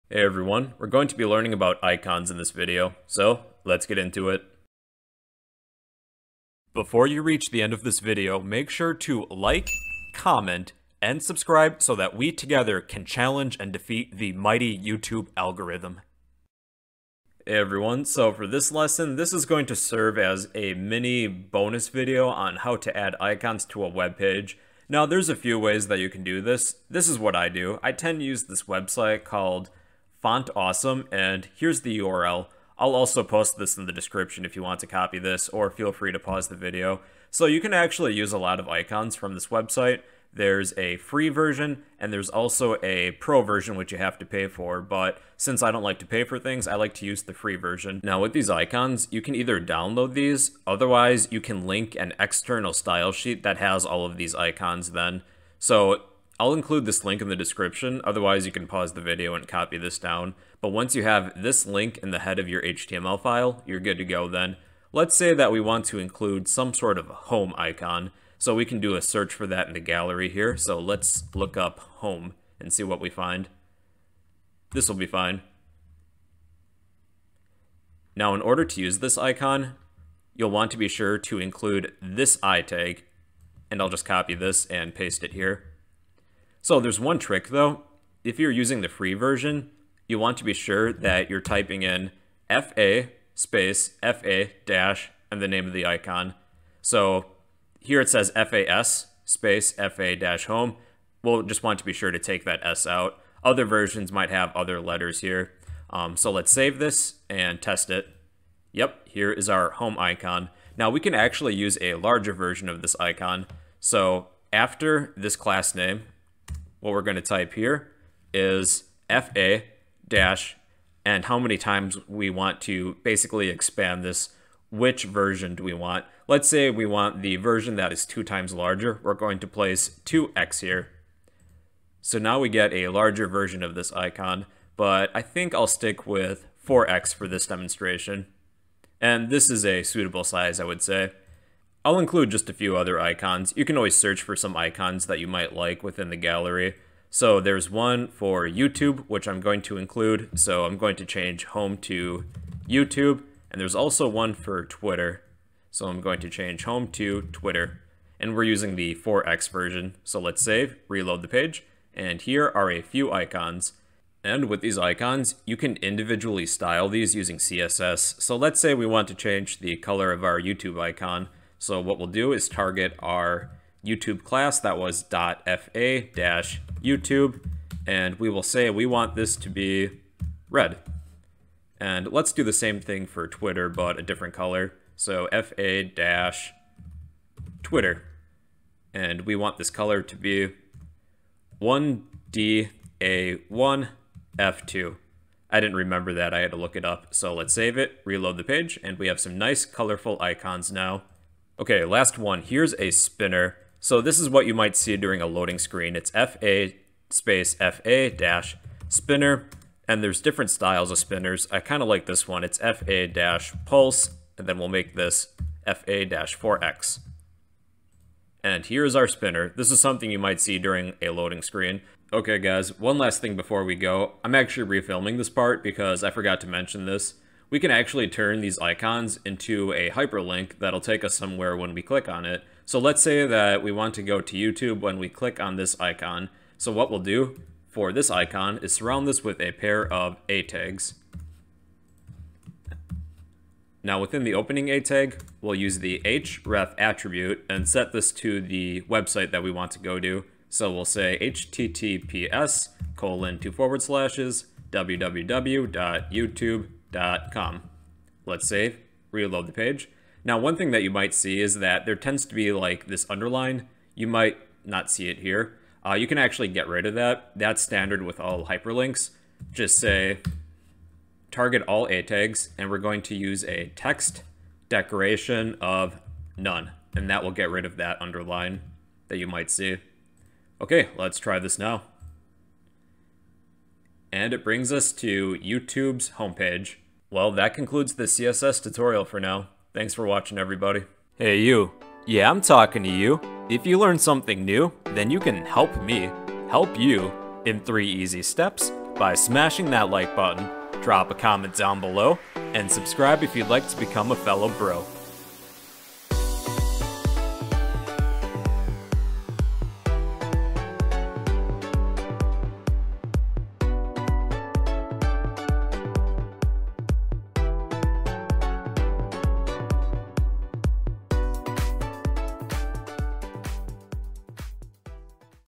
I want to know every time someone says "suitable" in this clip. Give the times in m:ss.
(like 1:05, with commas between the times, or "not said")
2:19.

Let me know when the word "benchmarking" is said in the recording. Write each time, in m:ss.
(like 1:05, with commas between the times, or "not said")
not said.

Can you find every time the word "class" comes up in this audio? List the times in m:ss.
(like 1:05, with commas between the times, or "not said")
1:55, 2:54.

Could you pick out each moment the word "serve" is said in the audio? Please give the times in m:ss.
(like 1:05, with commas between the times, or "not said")
0:19.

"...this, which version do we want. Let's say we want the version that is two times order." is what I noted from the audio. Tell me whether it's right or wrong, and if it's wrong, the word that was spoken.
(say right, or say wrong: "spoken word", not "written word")
wrong: "larger", not "order".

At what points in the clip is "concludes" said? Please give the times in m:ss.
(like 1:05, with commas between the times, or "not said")
4:47.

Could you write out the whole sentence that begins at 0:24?
Now there's a few ways that you can do this.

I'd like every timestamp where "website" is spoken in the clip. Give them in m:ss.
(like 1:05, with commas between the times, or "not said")
0:28, 0:39, 4:08.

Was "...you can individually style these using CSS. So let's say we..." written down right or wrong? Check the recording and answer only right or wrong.
right.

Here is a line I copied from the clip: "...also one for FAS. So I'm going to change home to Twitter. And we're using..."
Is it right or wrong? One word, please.
wrong.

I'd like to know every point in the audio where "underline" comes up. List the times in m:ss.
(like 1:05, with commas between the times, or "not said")
4:23, 4:38.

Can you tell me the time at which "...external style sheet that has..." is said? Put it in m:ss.
0:52.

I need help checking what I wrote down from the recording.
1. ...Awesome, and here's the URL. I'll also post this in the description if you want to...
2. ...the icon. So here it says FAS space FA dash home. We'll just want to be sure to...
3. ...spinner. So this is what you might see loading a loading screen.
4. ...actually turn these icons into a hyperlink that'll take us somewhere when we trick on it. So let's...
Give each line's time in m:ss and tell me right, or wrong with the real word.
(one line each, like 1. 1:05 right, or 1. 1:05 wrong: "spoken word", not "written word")
1. 0:30 right
2. 1:35 right
3. 3:22 wrong: "during", not "loading"
4. 3:47 wrong: "click", not "trick".